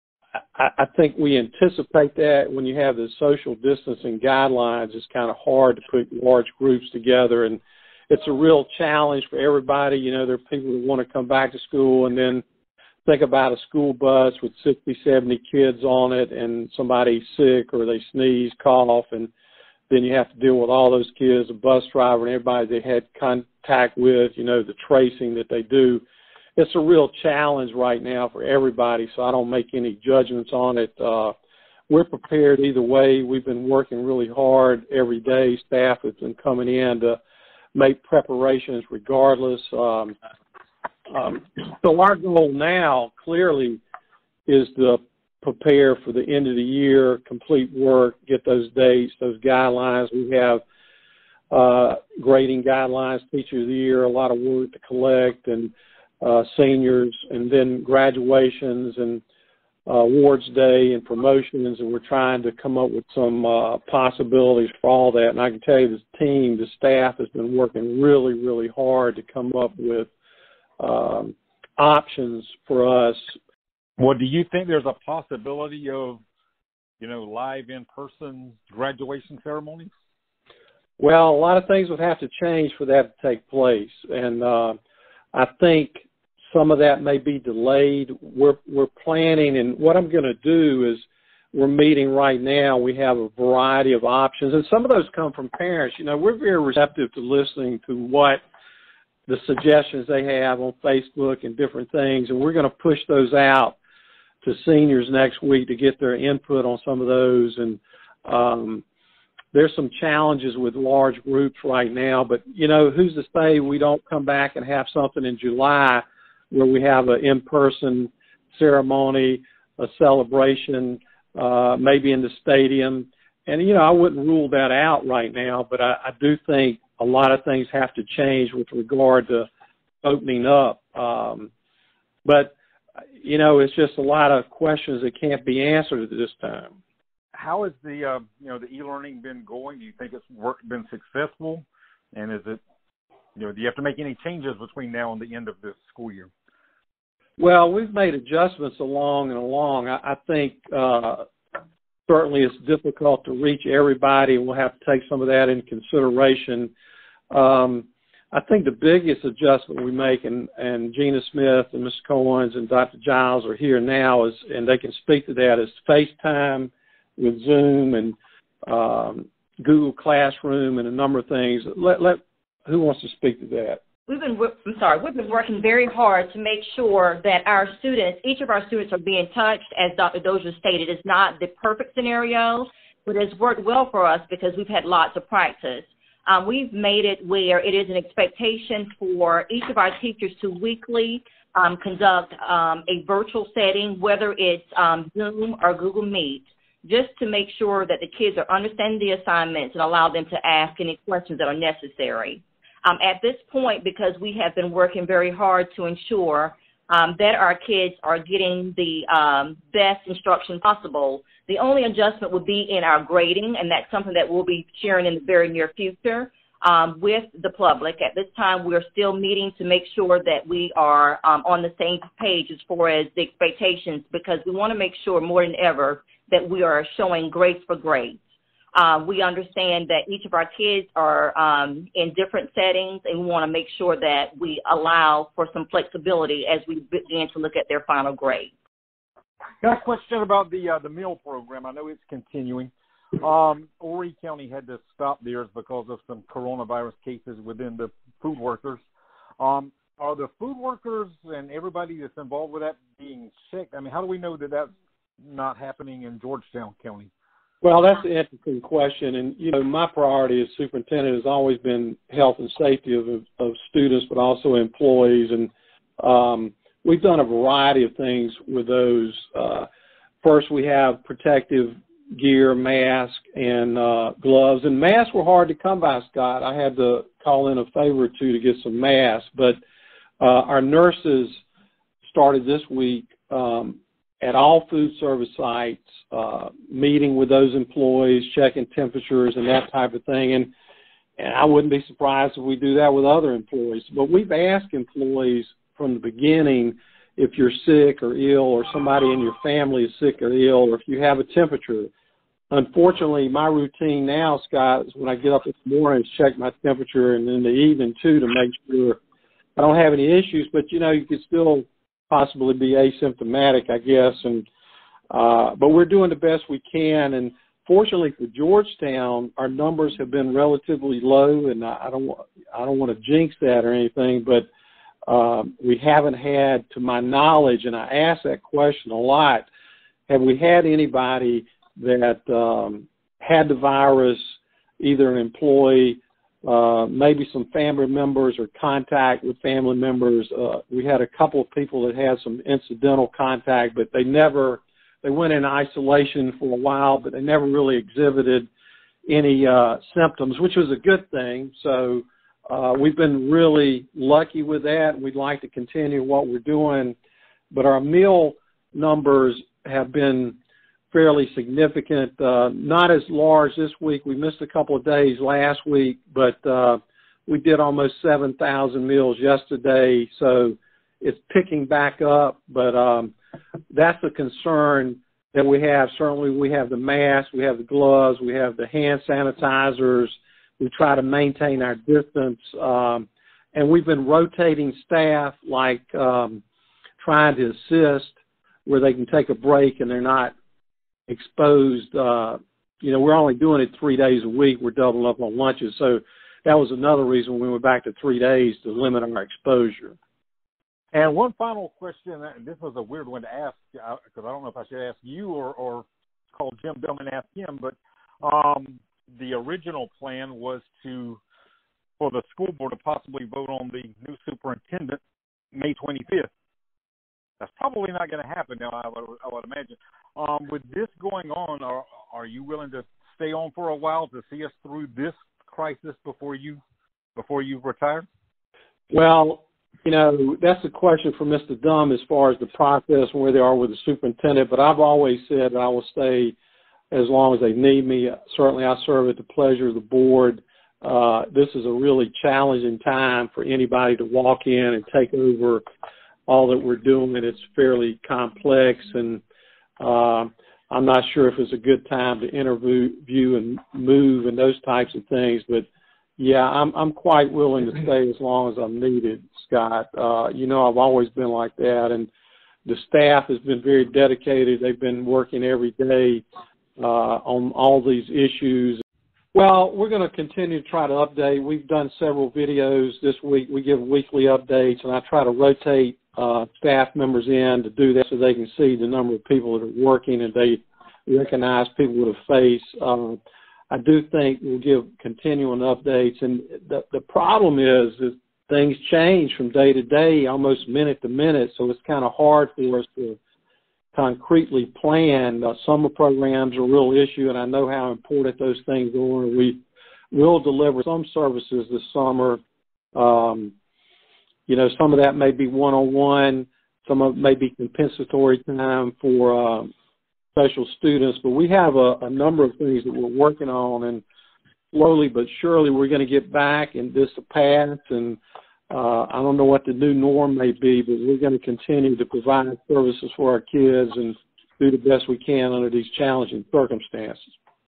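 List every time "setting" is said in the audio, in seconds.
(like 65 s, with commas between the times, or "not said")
193 s, 232 s.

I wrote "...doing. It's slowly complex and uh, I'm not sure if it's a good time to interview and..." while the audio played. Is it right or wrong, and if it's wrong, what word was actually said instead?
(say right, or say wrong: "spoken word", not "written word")
wrong: "fairly", not "slowly".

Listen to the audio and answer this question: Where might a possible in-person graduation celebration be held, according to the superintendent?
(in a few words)
the stadium.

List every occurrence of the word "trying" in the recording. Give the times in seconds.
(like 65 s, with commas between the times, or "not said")
62 s, 387 s.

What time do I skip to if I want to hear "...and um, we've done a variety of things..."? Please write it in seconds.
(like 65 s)
265 s.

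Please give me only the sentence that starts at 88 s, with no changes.
We're we're planning, and what I'm going to do is we're meeting right now.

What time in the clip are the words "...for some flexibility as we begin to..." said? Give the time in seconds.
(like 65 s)
235 s.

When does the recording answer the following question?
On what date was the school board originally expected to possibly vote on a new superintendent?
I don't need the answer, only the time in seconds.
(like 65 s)
415 s.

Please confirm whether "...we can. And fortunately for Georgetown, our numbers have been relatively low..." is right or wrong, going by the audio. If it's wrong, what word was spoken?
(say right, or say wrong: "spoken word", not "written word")
right.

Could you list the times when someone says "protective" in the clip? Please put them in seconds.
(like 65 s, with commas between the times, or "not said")
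271 s.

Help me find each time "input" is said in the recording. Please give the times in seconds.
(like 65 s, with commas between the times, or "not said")
106 s.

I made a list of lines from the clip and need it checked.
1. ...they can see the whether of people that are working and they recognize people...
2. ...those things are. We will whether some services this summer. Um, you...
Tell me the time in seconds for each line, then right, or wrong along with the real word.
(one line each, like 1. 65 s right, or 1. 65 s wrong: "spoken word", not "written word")
1. 478 s wrong: "number", not "whether"
2. 498 s wrong: "deliver", not "whether".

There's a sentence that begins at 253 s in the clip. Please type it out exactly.
I mean, how do we know that that's not happening in Georgetown County?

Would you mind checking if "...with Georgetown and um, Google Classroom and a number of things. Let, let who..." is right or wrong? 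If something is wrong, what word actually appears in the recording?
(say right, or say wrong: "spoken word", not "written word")
wrong: "Zoom", not "Georgetown".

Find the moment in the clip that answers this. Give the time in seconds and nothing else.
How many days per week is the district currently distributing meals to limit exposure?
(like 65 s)
393 s.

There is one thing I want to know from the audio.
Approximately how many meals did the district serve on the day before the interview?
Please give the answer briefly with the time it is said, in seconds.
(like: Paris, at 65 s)
7,000, at 367 s.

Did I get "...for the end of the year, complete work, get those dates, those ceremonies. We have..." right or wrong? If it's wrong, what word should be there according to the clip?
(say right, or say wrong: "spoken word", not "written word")
wrong: "guidelines", not "ceremonies".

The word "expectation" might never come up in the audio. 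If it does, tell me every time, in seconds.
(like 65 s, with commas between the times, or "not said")
187 s, 223 s.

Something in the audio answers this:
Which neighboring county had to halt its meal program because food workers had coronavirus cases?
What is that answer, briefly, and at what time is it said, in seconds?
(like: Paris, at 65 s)
Horry County, at 243 s.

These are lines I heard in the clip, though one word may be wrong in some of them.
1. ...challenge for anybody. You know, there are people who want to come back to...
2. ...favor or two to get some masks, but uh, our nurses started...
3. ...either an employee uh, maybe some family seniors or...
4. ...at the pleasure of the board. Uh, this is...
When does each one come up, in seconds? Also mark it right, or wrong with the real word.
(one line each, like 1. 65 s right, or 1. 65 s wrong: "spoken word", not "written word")
1. 8 s wrong: "everybody", not "anybody"
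2. 277 s right
3. 334 s wrong: "members", not "seniors"
4. 439 s right.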